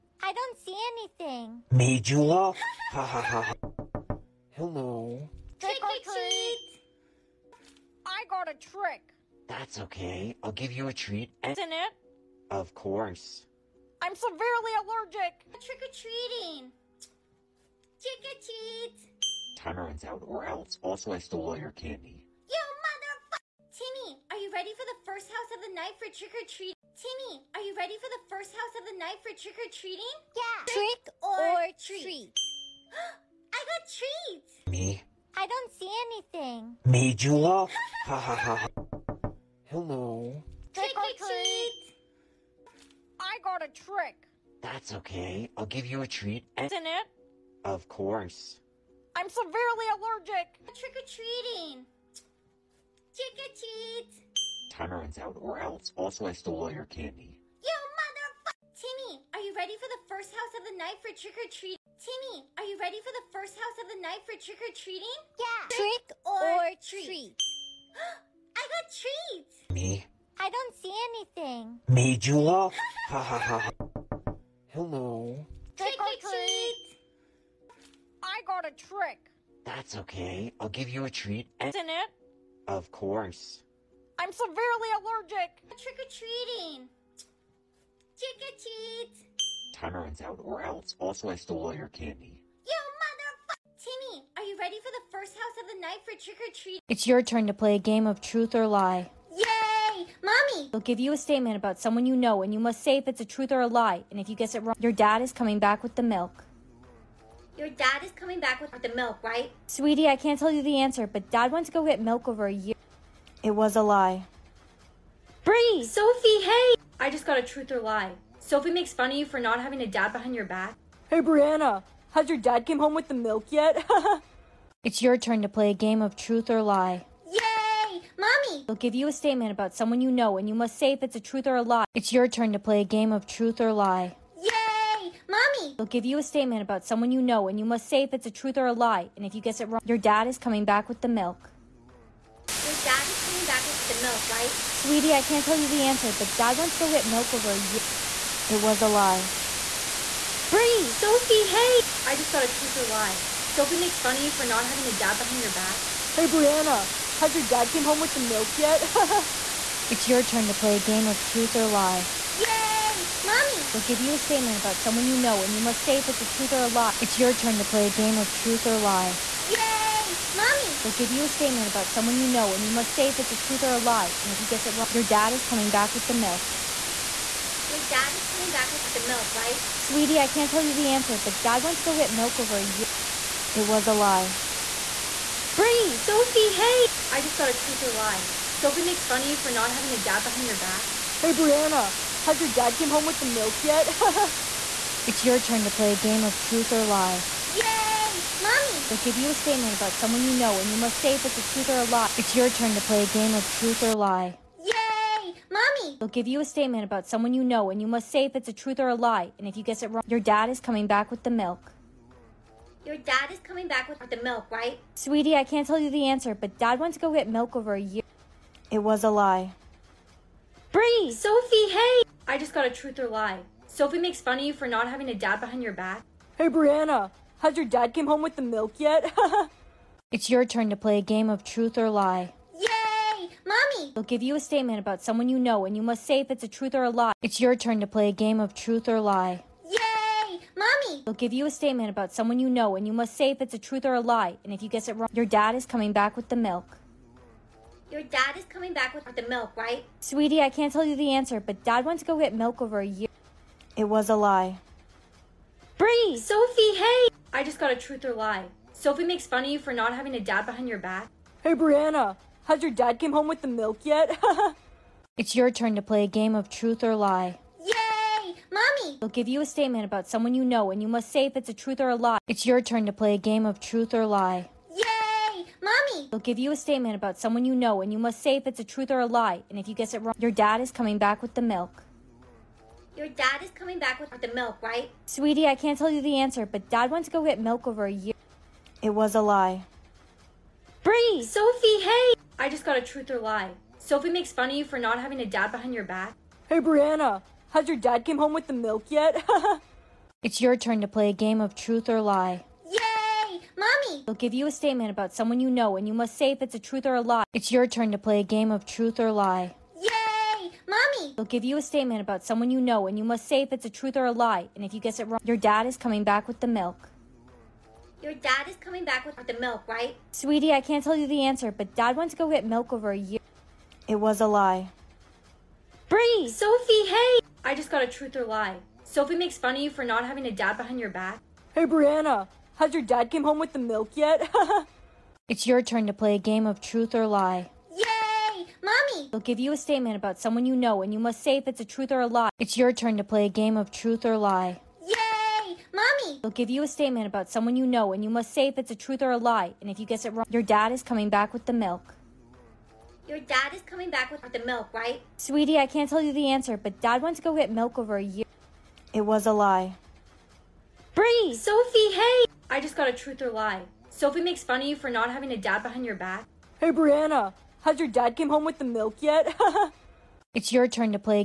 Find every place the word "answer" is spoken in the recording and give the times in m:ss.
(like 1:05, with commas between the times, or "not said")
1:50, 2:25, 3:00, 3:36, 4:11, 4:46, 5:21, 5:56.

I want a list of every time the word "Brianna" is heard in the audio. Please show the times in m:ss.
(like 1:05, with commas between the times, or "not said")
2:01, 2:36, 3:11, 3:46, 4:21, 4:56, 5:31, 6:06.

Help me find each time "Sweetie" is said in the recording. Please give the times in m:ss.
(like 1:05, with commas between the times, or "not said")
1:49, 2:24, 2:59, 3:34, 4:09, 4:45, 5:20, 5:55.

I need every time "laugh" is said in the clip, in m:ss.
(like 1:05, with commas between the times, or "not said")
0:37.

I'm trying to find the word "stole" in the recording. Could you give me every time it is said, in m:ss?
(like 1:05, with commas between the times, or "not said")
0:21, 0:56, 1:31.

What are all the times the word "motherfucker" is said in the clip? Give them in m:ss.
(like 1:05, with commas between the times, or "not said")
0:22, 0:57, 1:33.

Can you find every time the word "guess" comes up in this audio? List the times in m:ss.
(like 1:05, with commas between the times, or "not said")
1:44, 2:19, 2:54, 3:29, 4:04, 4:39, 5:14, 5:49.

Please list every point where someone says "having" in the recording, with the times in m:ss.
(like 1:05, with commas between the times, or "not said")
1:59, 2:34, 3:09, 3:44, 4:19, 4:54, 5:30, 6:05.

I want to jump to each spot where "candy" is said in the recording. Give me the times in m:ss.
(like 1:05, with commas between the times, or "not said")
0:21, 0:56, 1:31.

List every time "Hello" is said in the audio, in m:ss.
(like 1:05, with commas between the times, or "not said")
0:04, 0:39, 1:14.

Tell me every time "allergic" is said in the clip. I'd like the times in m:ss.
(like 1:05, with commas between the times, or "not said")
0:14, 0:49, 1:24.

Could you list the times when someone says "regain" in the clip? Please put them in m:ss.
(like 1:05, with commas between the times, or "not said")
not said.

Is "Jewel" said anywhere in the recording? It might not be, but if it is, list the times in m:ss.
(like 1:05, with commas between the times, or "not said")
0:01, 1:12.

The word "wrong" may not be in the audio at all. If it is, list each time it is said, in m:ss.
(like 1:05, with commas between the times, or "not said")
1:44, 2:19, 2:54, 3:29, 4:04, 4:40, 5:15, 5:50.